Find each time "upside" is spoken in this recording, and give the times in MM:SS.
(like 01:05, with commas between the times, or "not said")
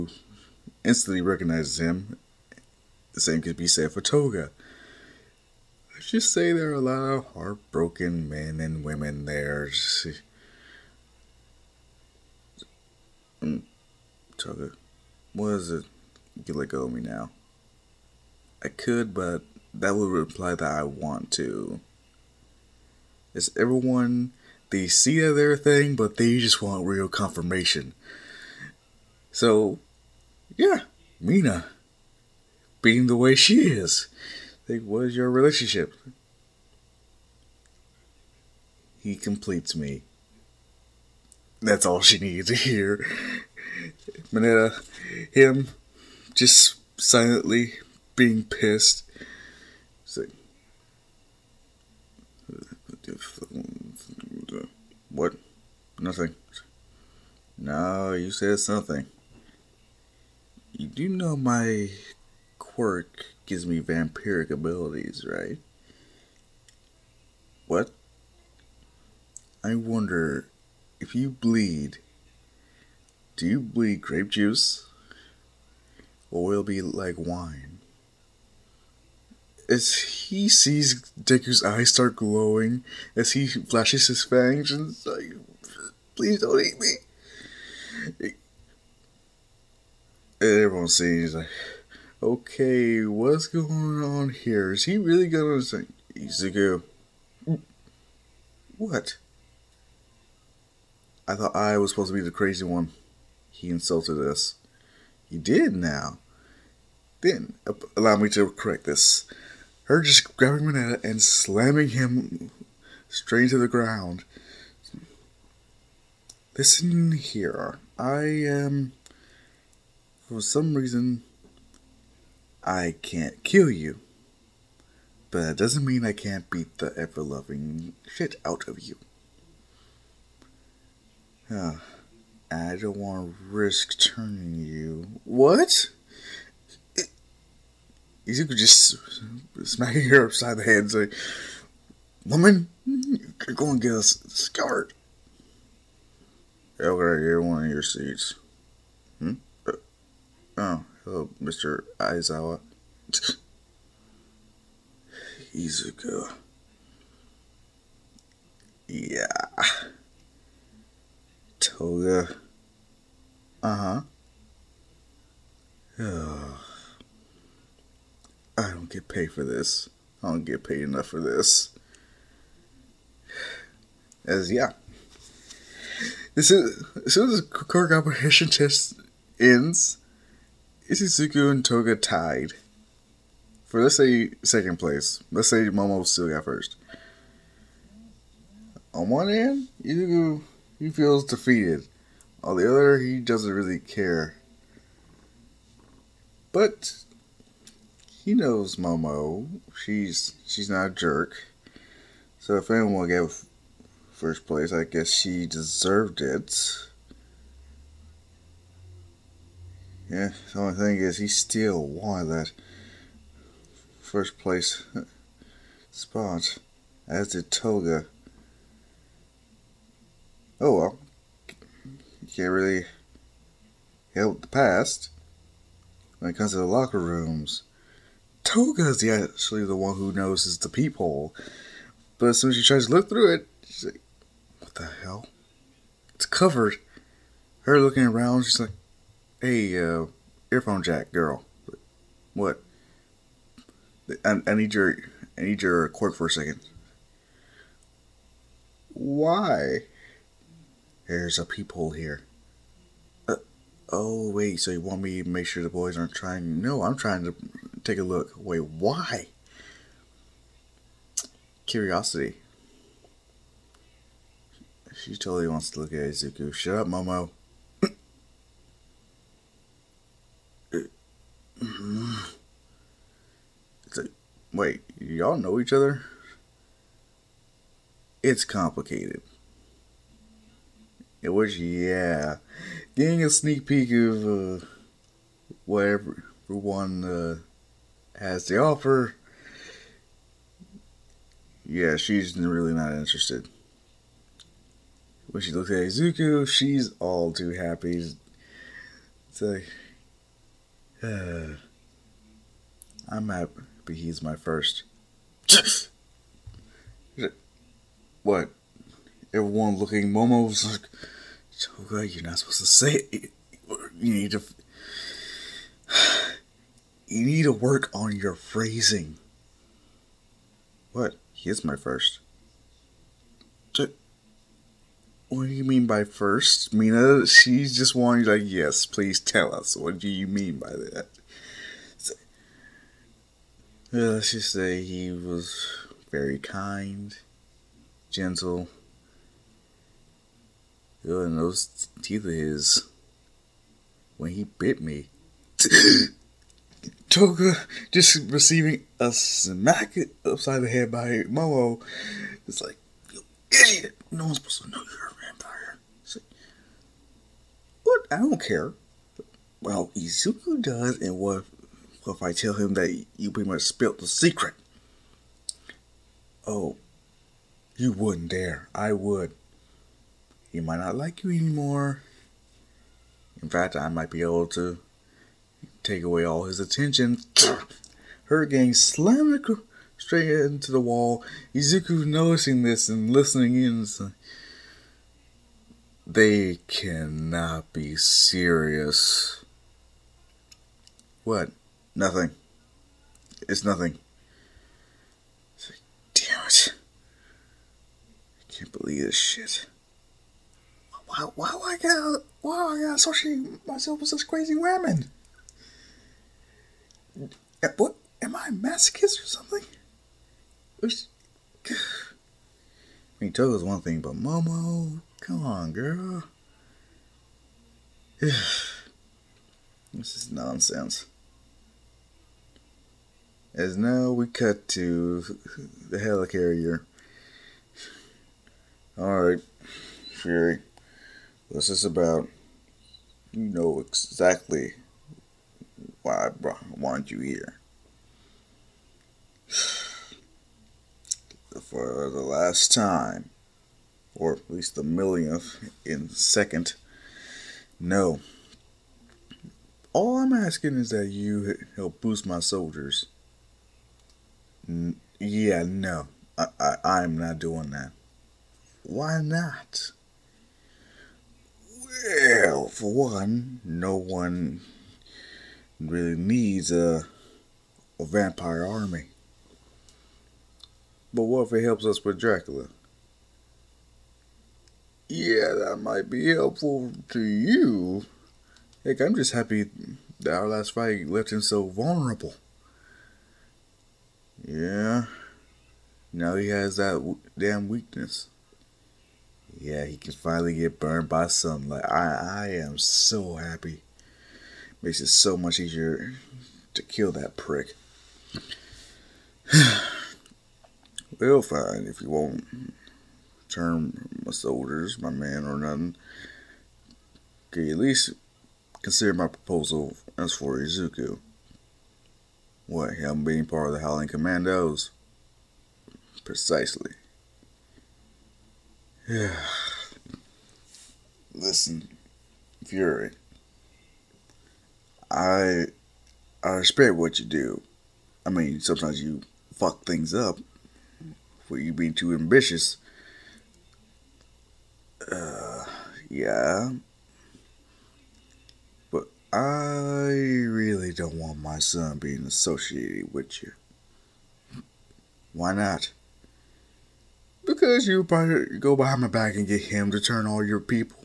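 02:20, 05:50.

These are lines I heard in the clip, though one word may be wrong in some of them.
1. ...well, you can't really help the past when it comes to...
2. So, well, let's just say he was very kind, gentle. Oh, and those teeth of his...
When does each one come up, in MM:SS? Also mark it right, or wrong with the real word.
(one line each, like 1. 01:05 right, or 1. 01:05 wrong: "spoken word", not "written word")
1. 03:40 right
2. 05:31 right.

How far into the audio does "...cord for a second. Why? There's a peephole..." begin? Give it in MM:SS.
04:05.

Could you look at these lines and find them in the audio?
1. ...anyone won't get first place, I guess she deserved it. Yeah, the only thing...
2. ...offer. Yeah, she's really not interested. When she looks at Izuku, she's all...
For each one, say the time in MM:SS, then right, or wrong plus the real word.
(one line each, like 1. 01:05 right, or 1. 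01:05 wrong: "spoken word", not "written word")
1. 03:22 right
2. 04:48 right.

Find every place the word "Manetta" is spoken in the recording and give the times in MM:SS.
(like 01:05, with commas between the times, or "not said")
00:44, 01:50.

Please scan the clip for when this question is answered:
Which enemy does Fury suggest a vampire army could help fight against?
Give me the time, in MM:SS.
07:52.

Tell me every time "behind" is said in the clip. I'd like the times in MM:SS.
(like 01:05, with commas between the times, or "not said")
09:08.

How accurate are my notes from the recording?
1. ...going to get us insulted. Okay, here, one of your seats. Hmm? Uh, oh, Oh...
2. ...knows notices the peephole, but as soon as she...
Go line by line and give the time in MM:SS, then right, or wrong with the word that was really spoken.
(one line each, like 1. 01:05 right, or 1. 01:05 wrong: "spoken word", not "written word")
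1. 02:23 wrong: "scarred", not "insulted"
2. 03:50 right.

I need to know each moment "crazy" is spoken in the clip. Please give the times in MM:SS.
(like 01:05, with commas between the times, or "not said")
01:42, 06:44.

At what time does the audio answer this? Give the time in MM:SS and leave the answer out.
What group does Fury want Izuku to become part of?
08:33.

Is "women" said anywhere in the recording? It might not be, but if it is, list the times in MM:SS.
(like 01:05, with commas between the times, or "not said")
00:08, 06:44.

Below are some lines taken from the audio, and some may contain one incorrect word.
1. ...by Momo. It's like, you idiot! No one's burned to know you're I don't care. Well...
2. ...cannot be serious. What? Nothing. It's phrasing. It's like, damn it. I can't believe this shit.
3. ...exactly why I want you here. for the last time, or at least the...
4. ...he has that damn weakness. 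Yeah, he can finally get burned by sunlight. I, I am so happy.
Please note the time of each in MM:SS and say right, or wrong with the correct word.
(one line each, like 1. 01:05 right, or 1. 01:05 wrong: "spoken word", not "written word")
1. 05:50 wrong: "supposed", not "burned"
2. 06:26 wrong: "nothing", not "phrasing"
3. 07:13 right
4. 08:06 right.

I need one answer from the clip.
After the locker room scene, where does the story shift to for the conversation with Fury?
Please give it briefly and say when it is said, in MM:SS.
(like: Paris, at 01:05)
The helicarrier, at 07:05.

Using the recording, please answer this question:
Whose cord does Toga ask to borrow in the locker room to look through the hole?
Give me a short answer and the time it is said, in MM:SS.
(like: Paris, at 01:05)
Earphone jack girl, at 04:00.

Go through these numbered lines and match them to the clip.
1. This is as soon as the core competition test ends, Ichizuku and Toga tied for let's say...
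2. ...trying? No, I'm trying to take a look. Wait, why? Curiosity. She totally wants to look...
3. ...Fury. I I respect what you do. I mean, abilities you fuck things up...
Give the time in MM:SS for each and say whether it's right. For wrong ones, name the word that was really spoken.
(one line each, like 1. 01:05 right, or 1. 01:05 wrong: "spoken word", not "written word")
1. 02:56 right
2. 04:16 right
3. 08:42 wrong: "sometimes", not "abilities".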